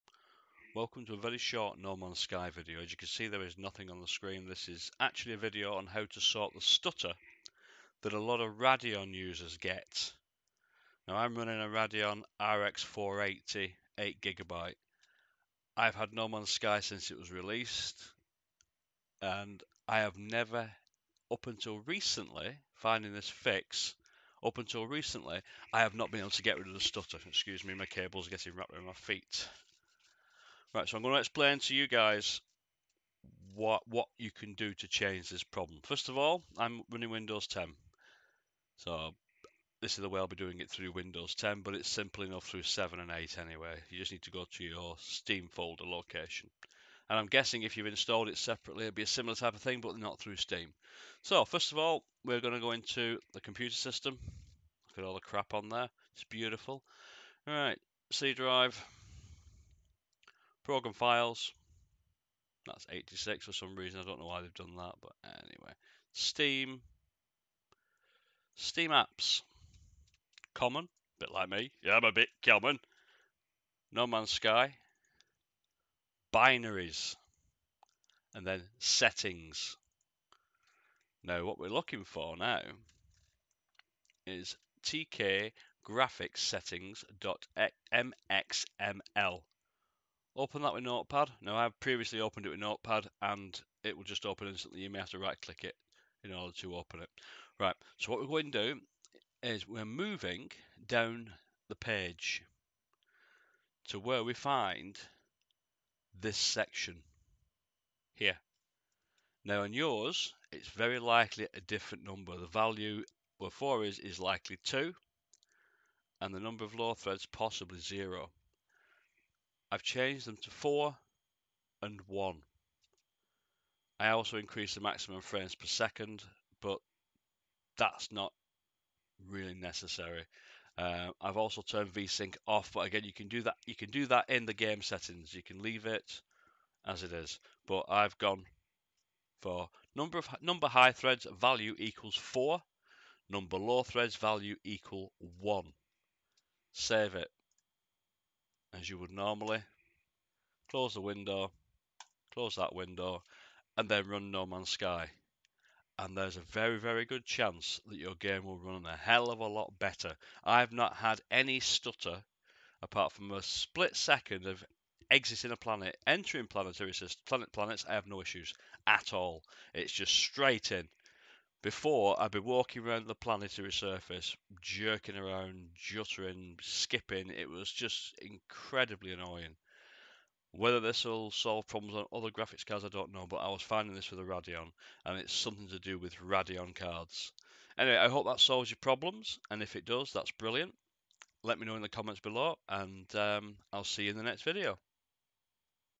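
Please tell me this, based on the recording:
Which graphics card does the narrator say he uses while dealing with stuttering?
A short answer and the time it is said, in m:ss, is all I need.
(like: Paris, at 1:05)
Radeon RX 480 8GB, at 0:11.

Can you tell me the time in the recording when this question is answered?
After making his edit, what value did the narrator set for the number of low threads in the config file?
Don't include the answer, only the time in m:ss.
2:23.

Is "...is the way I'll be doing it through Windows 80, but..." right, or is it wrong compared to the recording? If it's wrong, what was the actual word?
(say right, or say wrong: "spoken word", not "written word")
wrong: "10", not "80".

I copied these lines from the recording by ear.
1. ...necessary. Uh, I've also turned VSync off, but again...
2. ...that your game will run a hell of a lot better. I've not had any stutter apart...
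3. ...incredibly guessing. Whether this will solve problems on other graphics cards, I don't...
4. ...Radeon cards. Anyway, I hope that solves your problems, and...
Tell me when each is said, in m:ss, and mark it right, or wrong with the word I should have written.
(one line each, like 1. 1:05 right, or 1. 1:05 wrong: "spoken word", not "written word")
1. 2:09 right
2. 2:37 right
3. 2:58 wrong: "annoying", not "guessing"
4. 3:06 right.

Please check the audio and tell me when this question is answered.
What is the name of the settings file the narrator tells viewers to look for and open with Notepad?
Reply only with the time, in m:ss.
1:24.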